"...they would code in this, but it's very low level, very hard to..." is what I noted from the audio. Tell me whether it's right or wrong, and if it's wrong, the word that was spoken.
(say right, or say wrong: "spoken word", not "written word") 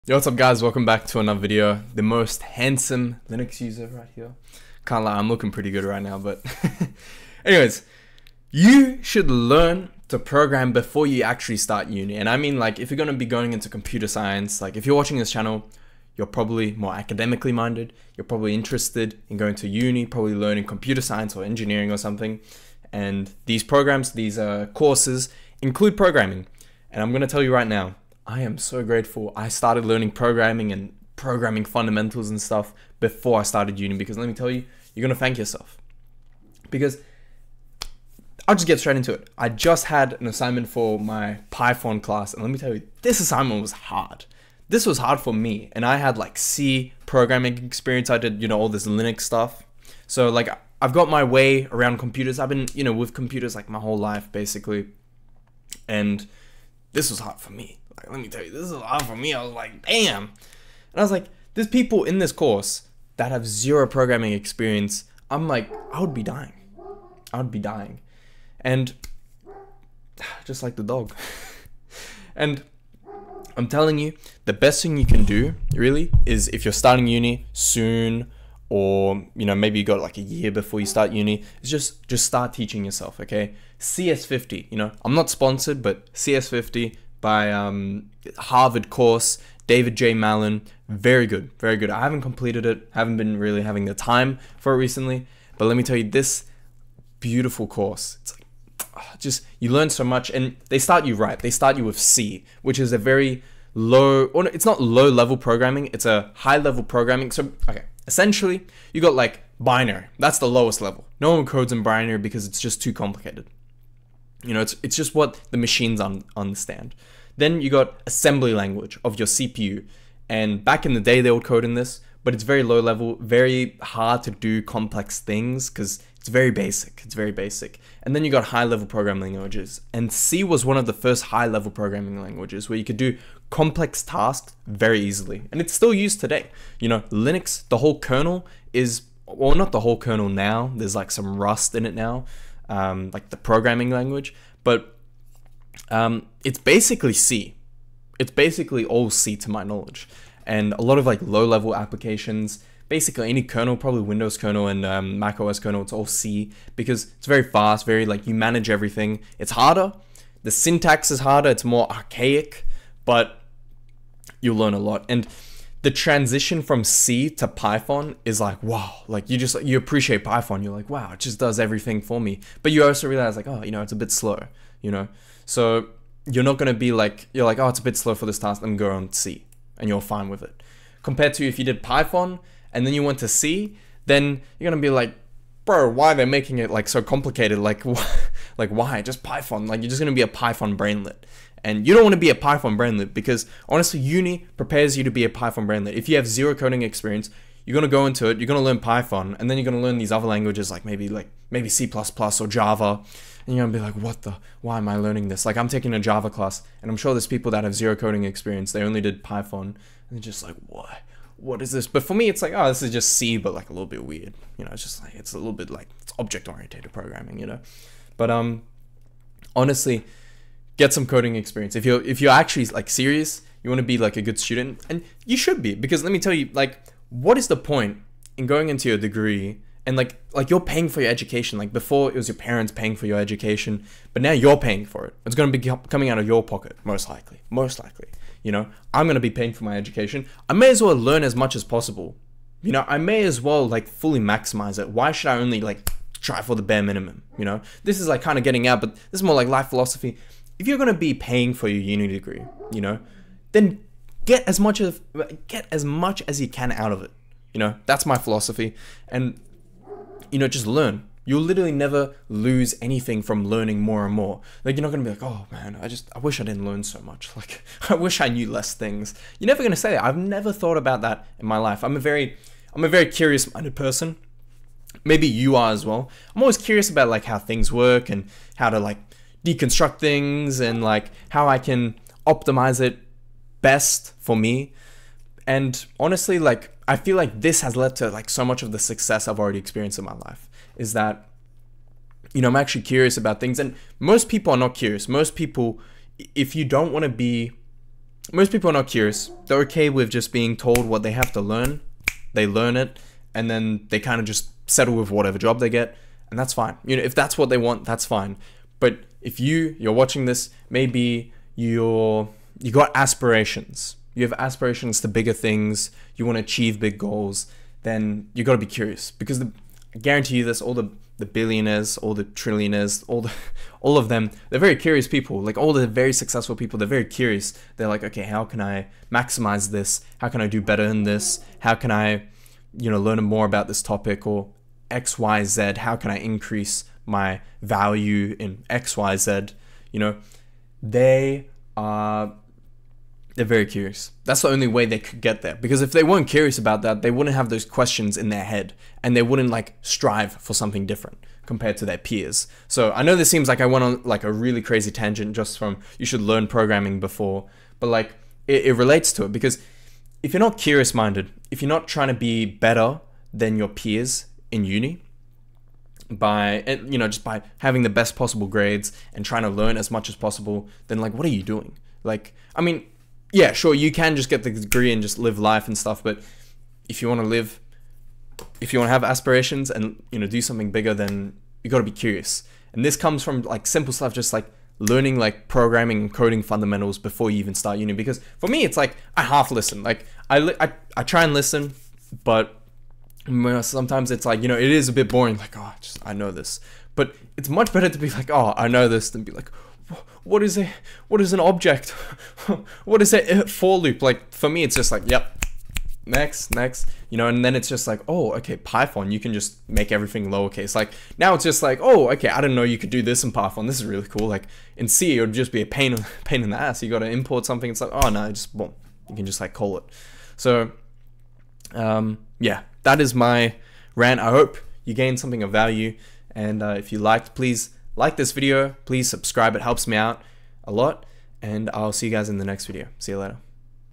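right.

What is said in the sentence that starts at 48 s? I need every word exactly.
I did, you know, all this Linux stuff.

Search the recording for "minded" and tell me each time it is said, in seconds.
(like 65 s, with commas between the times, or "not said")
17 s, 273 s, 360 s.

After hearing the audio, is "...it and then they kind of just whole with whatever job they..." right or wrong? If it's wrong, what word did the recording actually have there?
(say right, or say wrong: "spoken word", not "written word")
wrong: "settle", not "whole".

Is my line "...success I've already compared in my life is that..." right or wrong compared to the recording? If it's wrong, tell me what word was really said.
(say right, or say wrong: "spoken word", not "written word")
wrong: "experienced", not "compared".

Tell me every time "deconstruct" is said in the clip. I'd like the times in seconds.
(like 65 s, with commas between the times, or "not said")
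279 s.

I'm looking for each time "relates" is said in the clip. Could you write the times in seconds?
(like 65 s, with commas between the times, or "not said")
358 s.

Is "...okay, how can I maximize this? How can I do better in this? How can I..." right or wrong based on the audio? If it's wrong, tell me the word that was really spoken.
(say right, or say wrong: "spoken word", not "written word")
right.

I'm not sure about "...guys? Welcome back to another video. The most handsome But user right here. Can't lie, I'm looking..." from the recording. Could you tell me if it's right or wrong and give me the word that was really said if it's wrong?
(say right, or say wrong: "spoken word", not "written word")
wrong: "Linux", not "But".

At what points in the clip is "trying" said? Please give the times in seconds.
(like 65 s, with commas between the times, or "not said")
361 s, 369 s.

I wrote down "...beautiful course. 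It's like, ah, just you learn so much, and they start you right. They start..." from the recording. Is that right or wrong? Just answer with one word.
right.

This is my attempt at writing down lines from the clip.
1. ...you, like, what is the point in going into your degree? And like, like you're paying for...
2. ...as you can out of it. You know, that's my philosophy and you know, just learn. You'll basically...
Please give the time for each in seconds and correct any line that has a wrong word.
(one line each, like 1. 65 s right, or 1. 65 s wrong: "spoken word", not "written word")
1. 226 s right
2. 256 s wrong: "literally", not "basically".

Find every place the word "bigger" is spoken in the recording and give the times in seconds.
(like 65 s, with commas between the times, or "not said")
315 s, 380 s.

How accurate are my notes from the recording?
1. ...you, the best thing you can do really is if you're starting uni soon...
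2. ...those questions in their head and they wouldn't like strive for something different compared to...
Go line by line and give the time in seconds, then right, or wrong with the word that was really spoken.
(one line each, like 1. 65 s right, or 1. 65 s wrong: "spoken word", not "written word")
1. 73 s right
2. 347 s right.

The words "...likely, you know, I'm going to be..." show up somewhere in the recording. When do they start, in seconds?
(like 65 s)
237 s.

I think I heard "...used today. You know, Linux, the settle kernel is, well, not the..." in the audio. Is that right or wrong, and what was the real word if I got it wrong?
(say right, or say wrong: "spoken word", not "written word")
wrong: "whole", not "settle".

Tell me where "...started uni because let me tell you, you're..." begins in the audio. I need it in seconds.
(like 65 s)
33 s.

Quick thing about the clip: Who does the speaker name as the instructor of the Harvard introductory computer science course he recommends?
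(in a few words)
David J. Malan.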